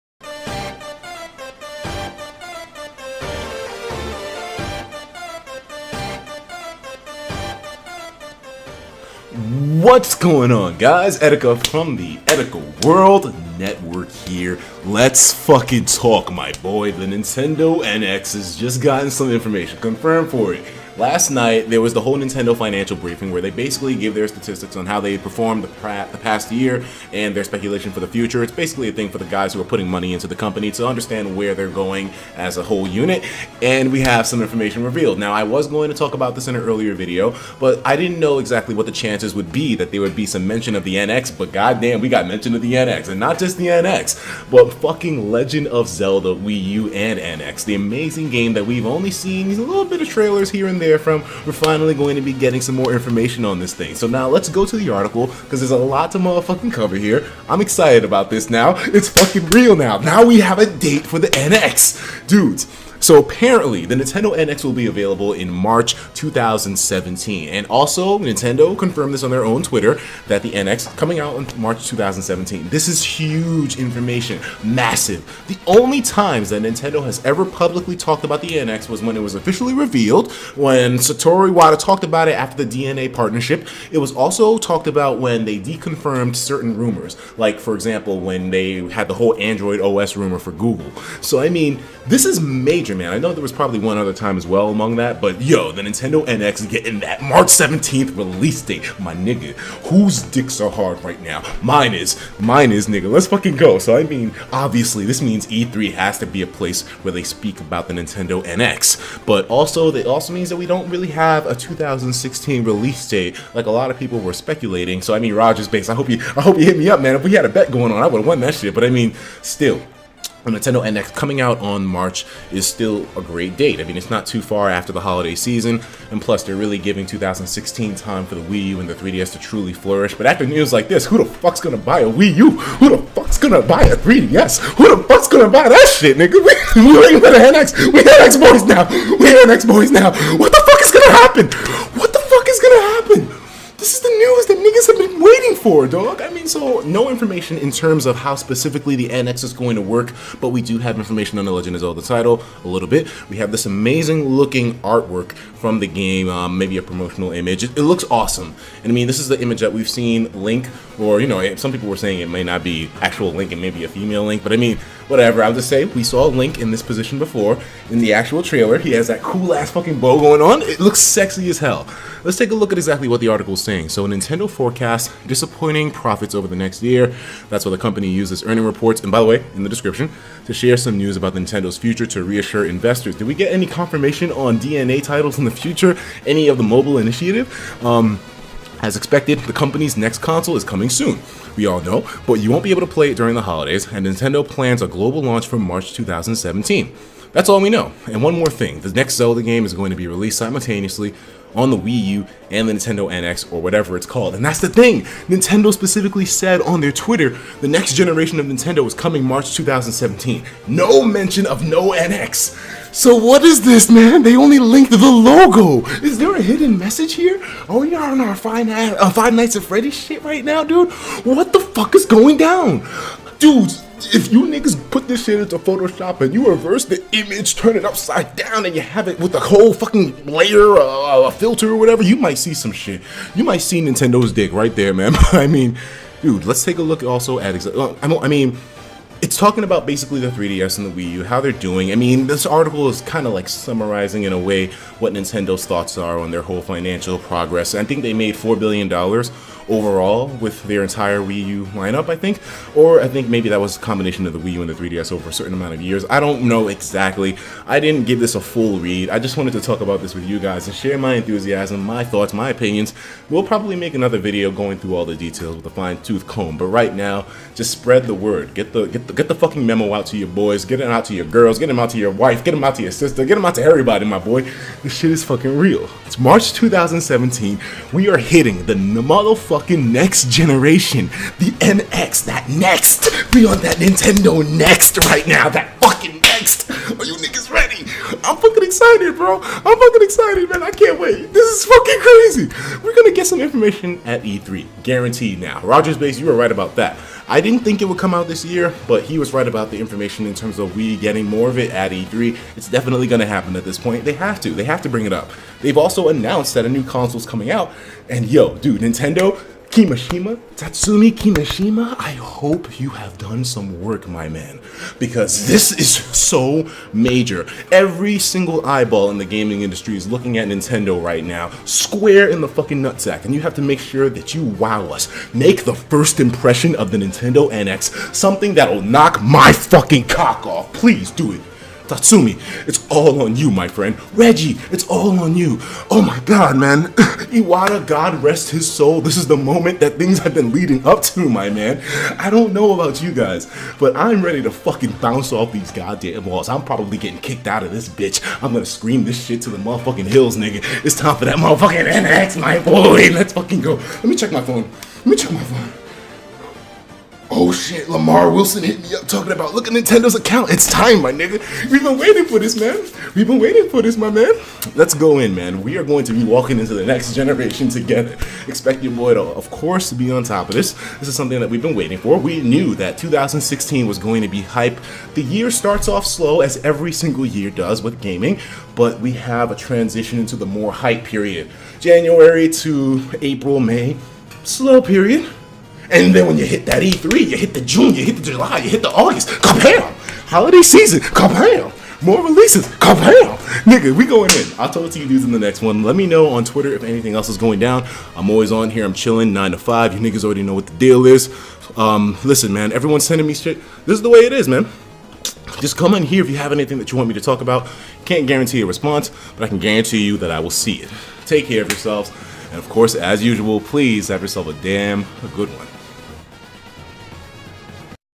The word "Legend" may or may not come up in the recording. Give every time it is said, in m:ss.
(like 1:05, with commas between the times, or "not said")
0:45, 2:31.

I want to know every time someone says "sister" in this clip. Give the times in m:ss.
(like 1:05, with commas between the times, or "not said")
4:32.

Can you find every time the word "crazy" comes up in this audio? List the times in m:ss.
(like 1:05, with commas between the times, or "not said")
4:51.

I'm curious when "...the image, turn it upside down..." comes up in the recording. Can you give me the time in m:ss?
3:46.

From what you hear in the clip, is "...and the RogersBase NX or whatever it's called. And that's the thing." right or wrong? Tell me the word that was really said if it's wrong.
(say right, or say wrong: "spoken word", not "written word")
wrong: "Nintendo", not "RogersBase".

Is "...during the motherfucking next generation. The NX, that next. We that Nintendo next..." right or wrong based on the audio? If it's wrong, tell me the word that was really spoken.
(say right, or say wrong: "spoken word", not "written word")
wrong: "hitting", not "during".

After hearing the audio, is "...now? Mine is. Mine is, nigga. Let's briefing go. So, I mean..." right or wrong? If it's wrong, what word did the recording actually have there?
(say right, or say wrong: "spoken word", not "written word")
wrong: "fucking", not "briefing".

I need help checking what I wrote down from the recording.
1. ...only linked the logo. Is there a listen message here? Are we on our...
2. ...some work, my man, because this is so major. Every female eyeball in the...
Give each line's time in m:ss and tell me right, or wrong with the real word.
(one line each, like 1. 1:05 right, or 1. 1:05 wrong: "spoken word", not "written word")
1. 3:34 wrong: "hidden", not "listen"
2. 5:13 wrong: "single", not "female".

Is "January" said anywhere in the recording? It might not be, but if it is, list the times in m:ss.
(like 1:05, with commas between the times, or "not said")
6:21.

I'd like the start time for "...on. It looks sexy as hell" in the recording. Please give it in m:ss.
2:50.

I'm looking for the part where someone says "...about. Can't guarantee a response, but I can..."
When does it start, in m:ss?
6:47.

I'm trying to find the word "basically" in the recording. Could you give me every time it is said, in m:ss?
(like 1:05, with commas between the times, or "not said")
0:23, 0:28, 3:59.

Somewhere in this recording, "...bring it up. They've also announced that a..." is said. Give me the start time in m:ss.
5:04.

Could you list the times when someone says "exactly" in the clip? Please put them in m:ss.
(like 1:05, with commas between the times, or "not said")
0:38, 2:52, 4:16.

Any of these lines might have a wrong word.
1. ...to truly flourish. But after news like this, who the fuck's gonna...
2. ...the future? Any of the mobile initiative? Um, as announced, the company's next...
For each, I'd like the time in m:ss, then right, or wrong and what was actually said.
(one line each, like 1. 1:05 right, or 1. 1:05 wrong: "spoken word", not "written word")
1. 2:09 right
2. 3:05 wrong: "expected", not "announced".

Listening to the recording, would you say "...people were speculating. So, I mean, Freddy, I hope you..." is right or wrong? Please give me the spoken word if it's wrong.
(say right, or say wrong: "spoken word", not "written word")
wrong: "RogersBase", not "Freddy".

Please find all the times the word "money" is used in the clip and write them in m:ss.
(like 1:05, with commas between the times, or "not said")
0:29.